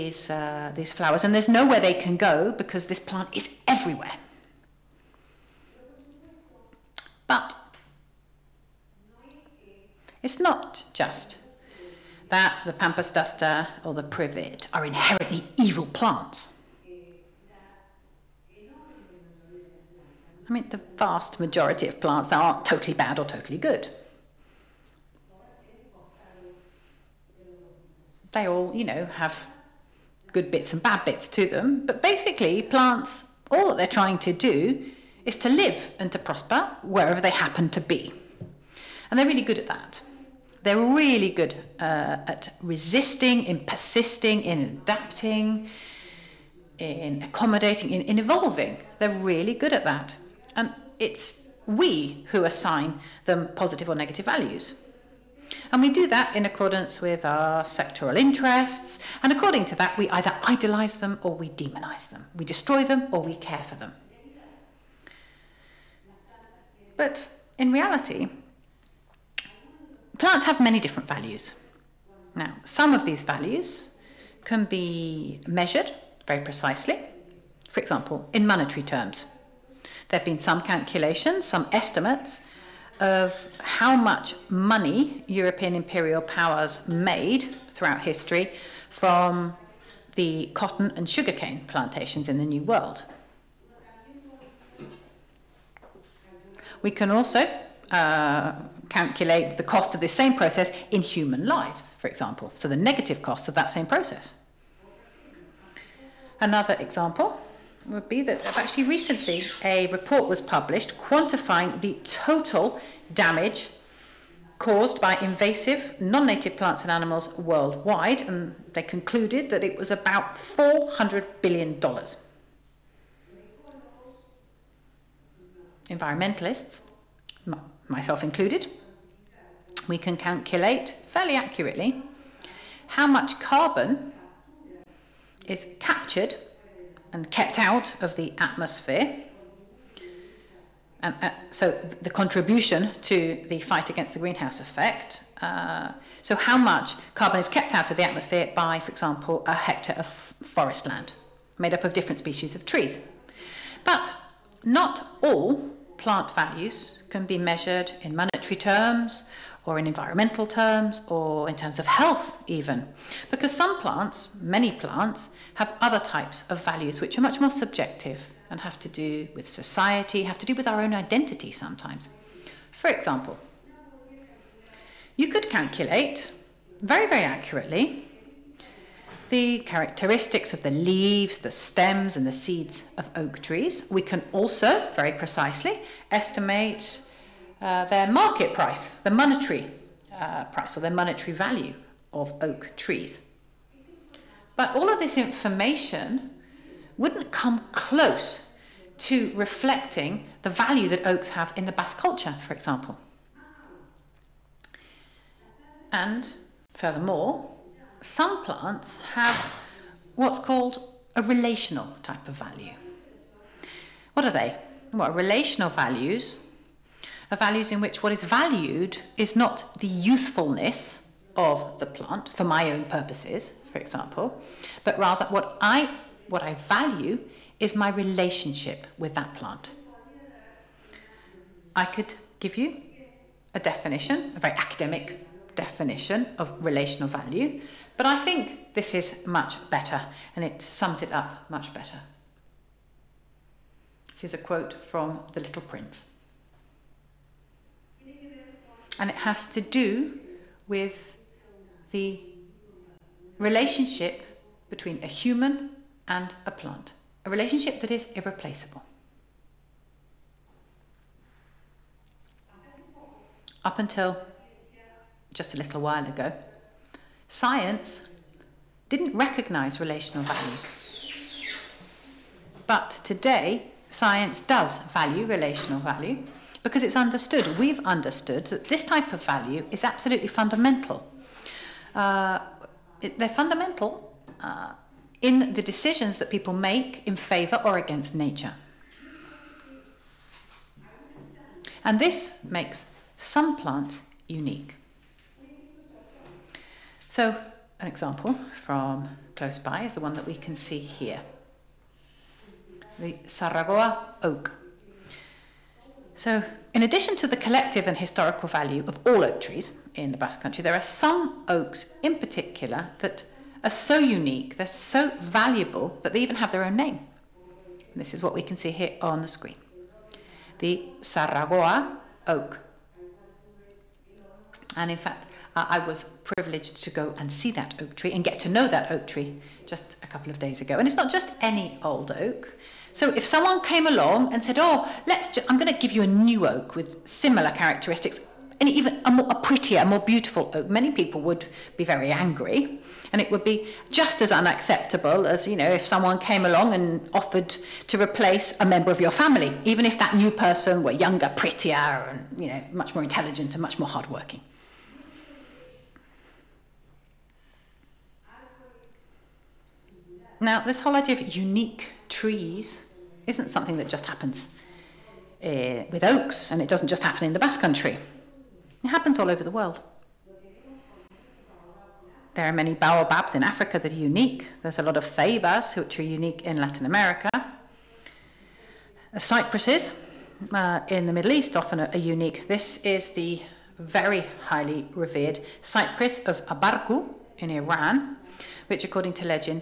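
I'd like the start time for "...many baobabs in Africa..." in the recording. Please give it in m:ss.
6:12.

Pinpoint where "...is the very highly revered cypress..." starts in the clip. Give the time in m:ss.
6:22.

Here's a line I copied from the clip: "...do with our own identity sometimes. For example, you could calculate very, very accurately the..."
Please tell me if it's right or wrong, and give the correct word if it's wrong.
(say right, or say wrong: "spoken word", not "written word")
right.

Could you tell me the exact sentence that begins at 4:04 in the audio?
This is a quote from The Little Prince.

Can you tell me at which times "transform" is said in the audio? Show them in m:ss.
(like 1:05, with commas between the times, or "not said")
not said.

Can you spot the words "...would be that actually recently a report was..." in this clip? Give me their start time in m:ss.
1:47.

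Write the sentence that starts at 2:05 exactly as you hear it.
Environmentalists myself included, we can calculate fairly accurately how much carbon is captured and kept out of the atmosphere.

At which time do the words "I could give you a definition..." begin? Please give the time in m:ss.
3:51.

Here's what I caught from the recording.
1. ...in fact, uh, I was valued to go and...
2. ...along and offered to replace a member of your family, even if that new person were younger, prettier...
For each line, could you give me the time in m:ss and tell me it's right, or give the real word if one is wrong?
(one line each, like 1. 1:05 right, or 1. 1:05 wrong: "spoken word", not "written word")
1. 5:24 wrong: "privileged", not "valued"
2. 5:46 right.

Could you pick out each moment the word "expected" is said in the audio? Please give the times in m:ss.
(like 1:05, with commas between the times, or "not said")
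not said.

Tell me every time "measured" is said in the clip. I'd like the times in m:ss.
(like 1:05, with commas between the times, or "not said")
1:15, 2:37.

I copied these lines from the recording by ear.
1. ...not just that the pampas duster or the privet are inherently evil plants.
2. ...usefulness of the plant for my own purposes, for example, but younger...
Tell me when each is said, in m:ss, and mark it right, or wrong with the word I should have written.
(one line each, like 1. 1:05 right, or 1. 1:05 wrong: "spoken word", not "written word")
1. 0:10 right
2. 3:39 wrong: "rather", not "younger".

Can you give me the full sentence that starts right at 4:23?
Up until just a little while ago, Science didn't recognize relational value.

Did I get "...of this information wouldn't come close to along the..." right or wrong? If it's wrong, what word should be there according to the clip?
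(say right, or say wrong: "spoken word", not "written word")
wrong: "reflecting", not "along".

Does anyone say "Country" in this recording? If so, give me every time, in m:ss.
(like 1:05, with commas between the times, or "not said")
5:10, 6:07.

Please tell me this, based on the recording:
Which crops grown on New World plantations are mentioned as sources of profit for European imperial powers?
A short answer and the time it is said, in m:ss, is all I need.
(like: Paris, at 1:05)
cotton and sugarcane, at 1:30.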